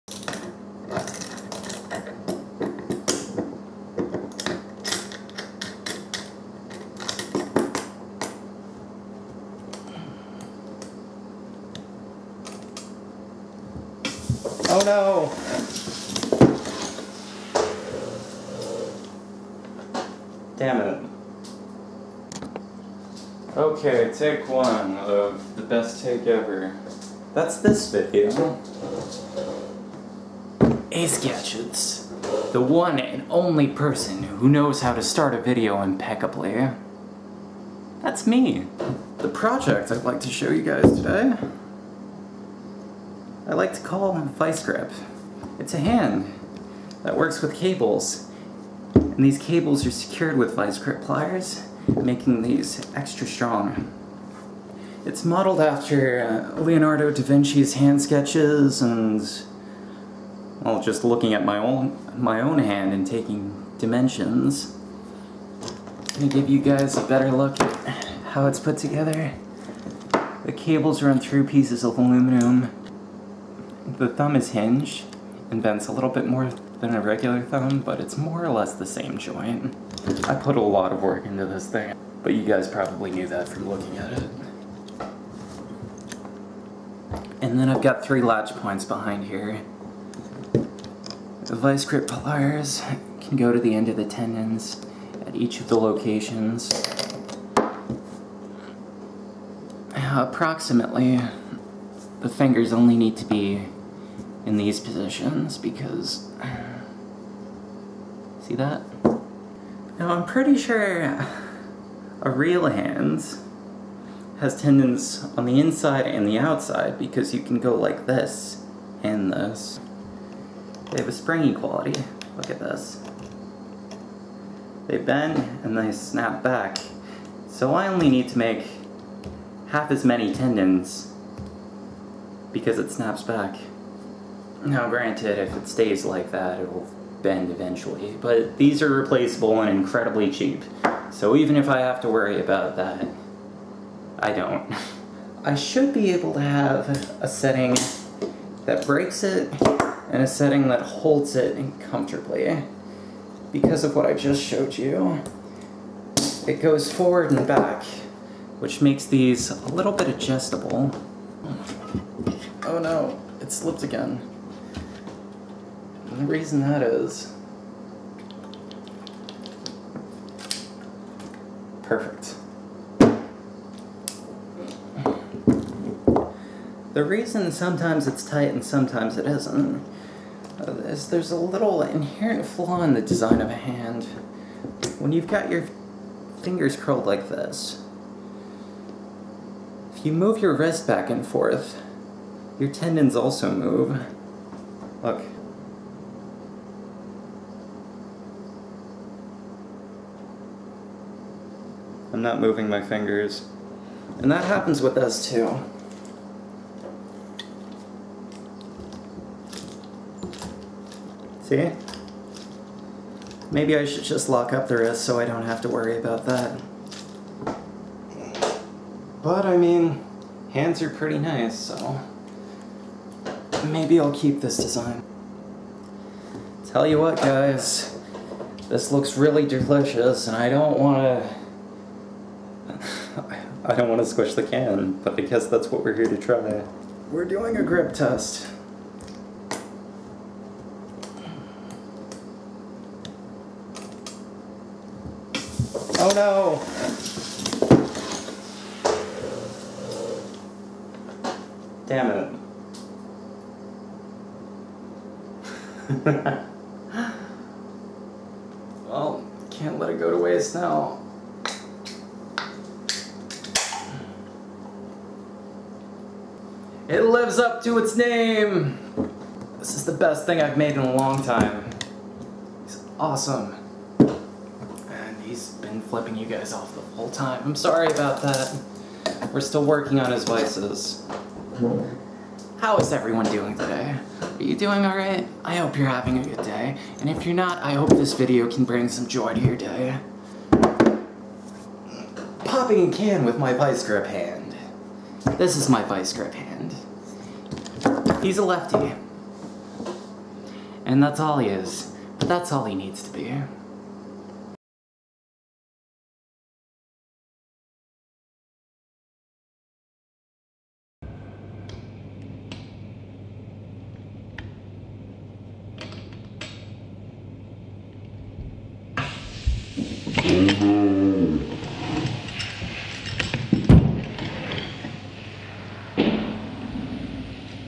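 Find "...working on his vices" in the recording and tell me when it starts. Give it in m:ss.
4:39.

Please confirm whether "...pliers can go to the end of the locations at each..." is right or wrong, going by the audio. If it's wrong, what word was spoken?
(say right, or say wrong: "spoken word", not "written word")
wrong: "tendons", not "locations".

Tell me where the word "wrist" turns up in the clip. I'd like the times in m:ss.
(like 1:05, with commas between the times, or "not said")
3:10, 3:34.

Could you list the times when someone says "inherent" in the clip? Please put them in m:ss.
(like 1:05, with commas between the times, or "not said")
3:01.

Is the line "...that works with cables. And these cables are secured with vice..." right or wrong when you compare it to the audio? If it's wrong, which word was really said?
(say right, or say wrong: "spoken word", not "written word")
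right.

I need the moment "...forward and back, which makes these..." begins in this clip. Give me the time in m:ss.
2:36.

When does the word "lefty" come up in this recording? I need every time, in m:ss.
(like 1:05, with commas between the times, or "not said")
4:58.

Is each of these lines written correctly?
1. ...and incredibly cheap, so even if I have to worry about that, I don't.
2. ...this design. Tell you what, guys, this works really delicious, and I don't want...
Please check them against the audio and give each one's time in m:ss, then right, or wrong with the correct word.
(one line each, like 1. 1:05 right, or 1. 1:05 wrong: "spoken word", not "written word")
1. 2:19 right
2. 3:44 wrong: "looks", not "works".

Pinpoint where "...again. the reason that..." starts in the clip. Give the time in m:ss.
2:43.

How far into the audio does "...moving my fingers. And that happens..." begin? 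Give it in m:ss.
3:22.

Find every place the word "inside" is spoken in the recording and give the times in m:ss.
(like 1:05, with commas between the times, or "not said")
1:55.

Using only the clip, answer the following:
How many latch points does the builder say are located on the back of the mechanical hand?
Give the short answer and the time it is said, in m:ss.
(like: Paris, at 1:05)
3, at 1:28.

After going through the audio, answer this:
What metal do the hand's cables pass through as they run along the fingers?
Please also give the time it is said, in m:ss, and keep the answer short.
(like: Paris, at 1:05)
Aluminum, at 1:11.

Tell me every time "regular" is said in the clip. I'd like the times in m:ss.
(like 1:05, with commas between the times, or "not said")
1:17.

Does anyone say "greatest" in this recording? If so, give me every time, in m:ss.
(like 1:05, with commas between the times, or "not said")
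not said.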